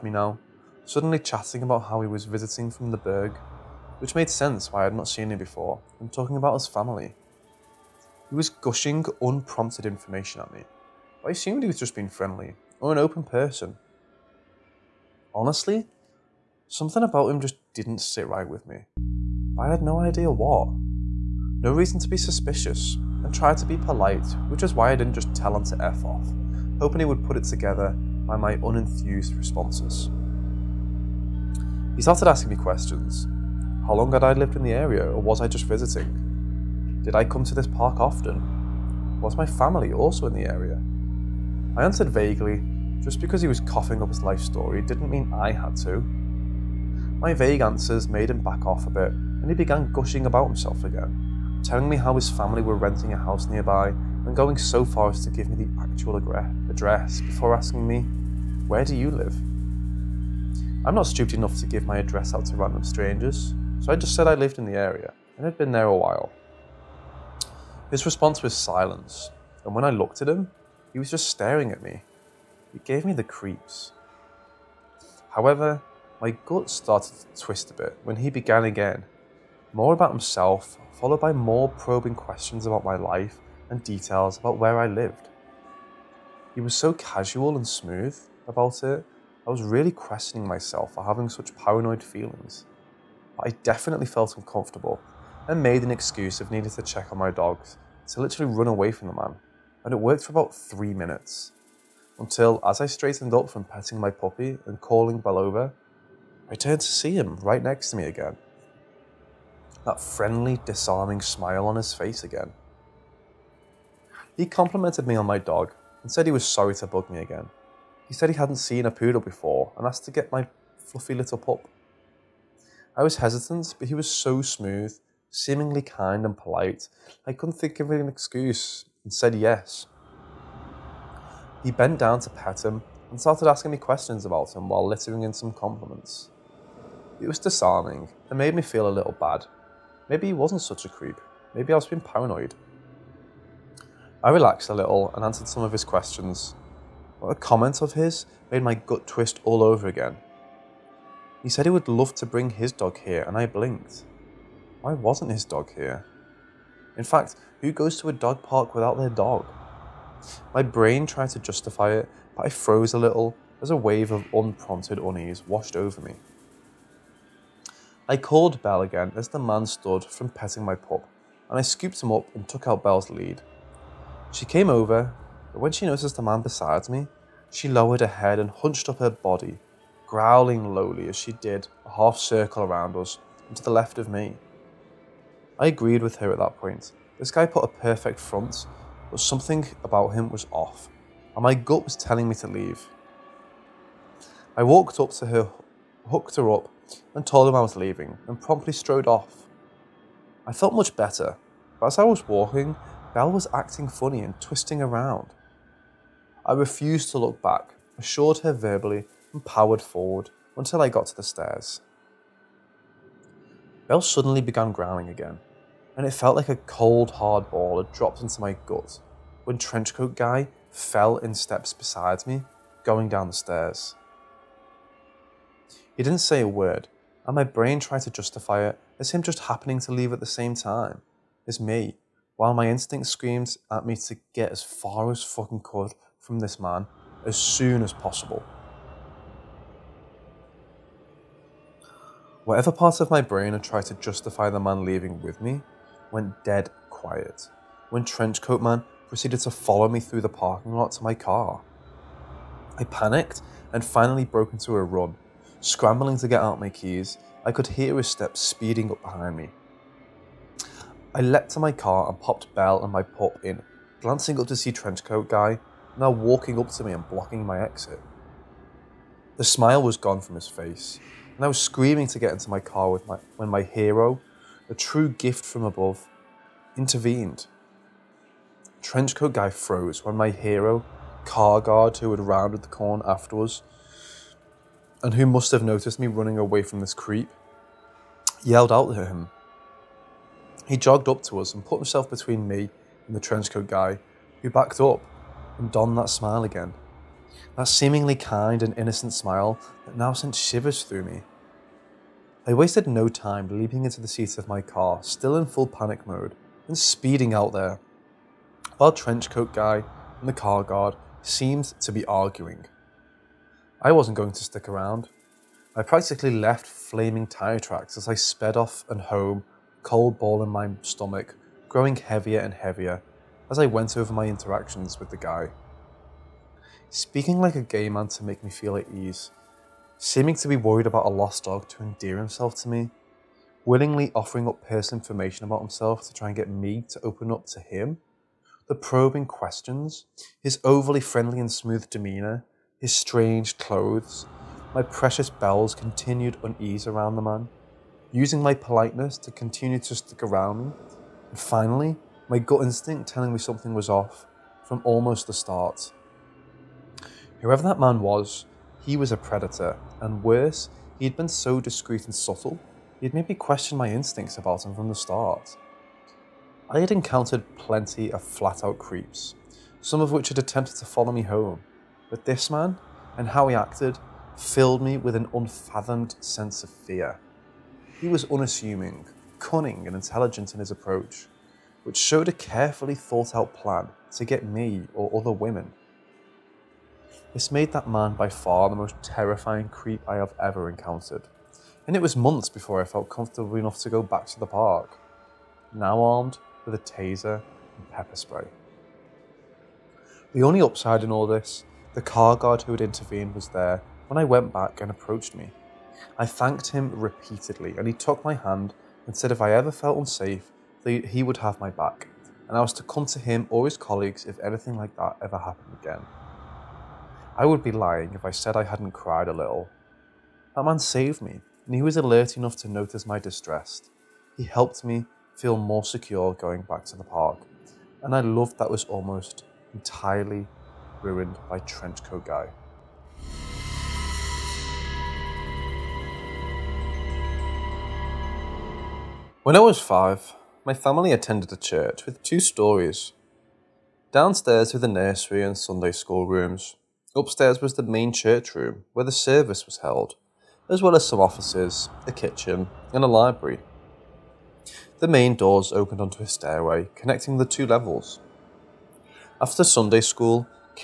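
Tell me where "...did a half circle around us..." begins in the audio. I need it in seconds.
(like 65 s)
181 s.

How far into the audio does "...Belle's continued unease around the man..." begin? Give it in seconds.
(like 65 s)
345 s.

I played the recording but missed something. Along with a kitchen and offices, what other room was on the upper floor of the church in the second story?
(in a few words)
library.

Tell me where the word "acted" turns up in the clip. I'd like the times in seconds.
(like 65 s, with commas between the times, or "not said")
373 s.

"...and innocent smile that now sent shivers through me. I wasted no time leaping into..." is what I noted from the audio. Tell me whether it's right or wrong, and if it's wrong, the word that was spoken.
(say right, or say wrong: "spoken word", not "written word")
right.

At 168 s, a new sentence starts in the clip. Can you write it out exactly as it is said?
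I called again as the man stood from petting my pup, and I scooped him up and took out Belle's lead.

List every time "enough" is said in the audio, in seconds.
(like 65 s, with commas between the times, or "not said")
61 s, 393 s, 422 s.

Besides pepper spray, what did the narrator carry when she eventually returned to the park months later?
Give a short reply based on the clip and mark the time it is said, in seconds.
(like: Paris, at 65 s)
taser, at 396 s.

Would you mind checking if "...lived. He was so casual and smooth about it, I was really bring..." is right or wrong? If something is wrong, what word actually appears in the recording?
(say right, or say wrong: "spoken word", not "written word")
wrong: "questioning", not "bring".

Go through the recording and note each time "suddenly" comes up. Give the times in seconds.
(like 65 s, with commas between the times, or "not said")
0 s, 214 s.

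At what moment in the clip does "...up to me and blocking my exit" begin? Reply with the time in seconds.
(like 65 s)
266 s.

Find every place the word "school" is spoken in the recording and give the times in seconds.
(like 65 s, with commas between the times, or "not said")
445 s, 460 s.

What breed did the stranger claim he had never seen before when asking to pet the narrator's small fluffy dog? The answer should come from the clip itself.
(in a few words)
poodle.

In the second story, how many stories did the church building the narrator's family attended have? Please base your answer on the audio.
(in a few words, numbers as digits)
2.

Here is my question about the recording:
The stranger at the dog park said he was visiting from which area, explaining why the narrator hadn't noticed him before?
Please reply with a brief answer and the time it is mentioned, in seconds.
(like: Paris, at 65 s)
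the Berg, at 2 s.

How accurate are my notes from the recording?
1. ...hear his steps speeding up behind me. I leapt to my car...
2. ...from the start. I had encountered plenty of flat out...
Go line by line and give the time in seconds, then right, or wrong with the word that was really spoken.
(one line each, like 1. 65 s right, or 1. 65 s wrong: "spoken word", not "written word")
1. 257 s right
2. 364 s right.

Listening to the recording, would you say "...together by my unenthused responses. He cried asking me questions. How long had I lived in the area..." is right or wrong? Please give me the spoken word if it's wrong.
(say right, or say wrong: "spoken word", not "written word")
wrong: "started", not "cried".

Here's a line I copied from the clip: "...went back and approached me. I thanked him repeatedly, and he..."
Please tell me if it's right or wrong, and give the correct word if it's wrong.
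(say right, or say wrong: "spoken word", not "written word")
right.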